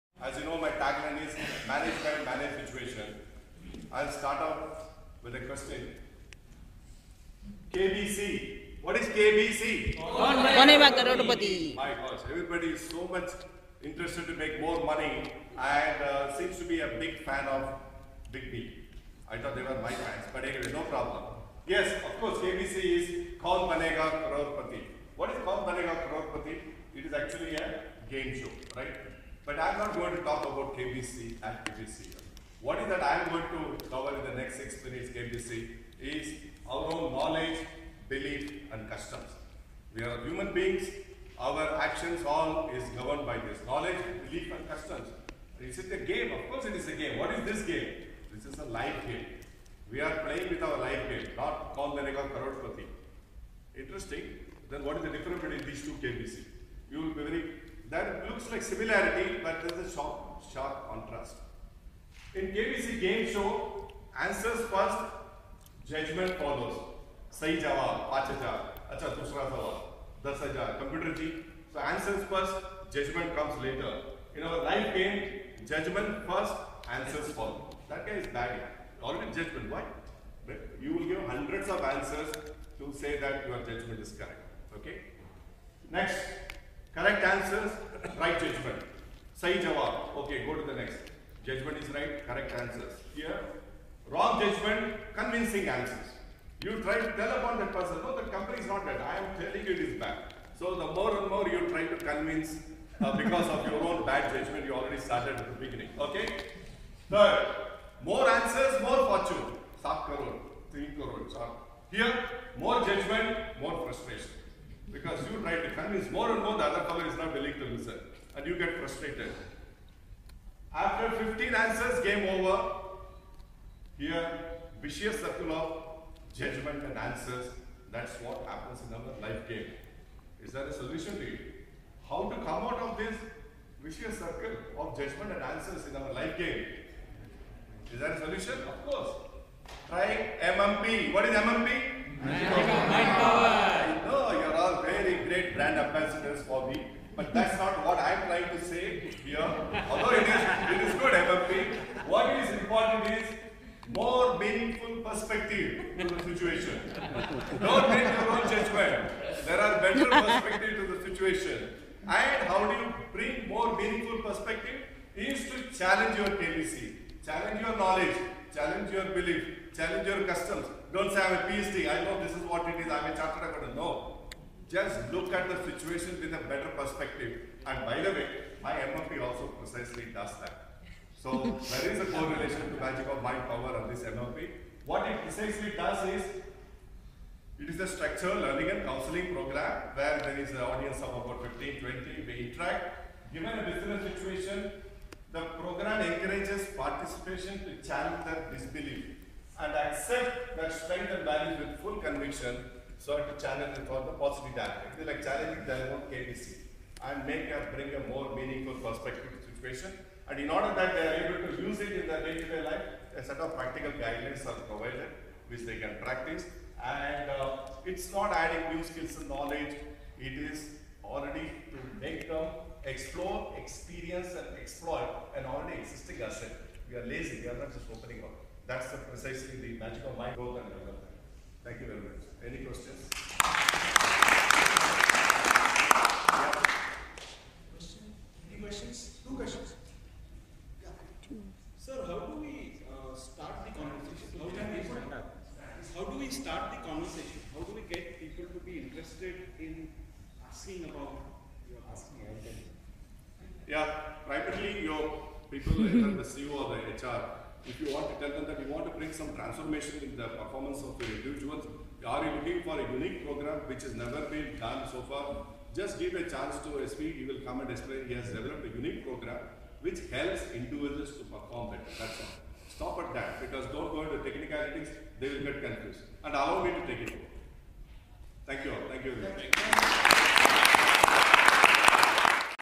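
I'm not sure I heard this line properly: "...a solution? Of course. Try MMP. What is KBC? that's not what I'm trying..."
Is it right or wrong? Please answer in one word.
wrong.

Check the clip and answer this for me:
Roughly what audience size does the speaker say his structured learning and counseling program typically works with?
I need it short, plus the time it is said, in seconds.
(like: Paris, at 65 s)
15 to 20, at 191 s.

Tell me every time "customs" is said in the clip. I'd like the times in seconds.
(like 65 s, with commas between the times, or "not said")
38 s, 44 s, 170 s.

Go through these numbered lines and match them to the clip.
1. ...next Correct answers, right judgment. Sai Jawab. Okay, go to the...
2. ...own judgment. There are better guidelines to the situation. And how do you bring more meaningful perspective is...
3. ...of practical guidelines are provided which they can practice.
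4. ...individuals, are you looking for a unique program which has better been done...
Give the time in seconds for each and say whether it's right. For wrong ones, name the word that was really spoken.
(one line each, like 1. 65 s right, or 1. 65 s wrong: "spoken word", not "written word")
1. 85 s right
2. 158 s wrong: "perspectives", not "guidelines"
3. 213 s right
4. 261 s wrong: "never", not "better".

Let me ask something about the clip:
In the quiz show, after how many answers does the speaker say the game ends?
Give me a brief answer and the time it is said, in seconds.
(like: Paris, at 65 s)
15, at 121 s.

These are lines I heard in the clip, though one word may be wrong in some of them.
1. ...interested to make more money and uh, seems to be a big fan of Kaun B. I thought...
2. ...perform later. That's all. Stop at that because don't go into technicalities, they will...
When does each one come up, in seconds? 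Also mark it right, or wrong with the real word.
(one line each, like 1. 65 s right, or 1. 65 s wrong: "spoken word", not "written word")
1. 13 s wrong: "Big", not "Kaun"
2. 271 s wrong: "better", not "later".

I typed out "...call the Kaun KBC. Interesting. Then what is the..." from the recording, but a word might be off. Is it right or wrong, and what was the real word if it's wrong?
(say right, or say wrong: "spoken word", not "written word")
wrong: "Karodpati", not "KBC".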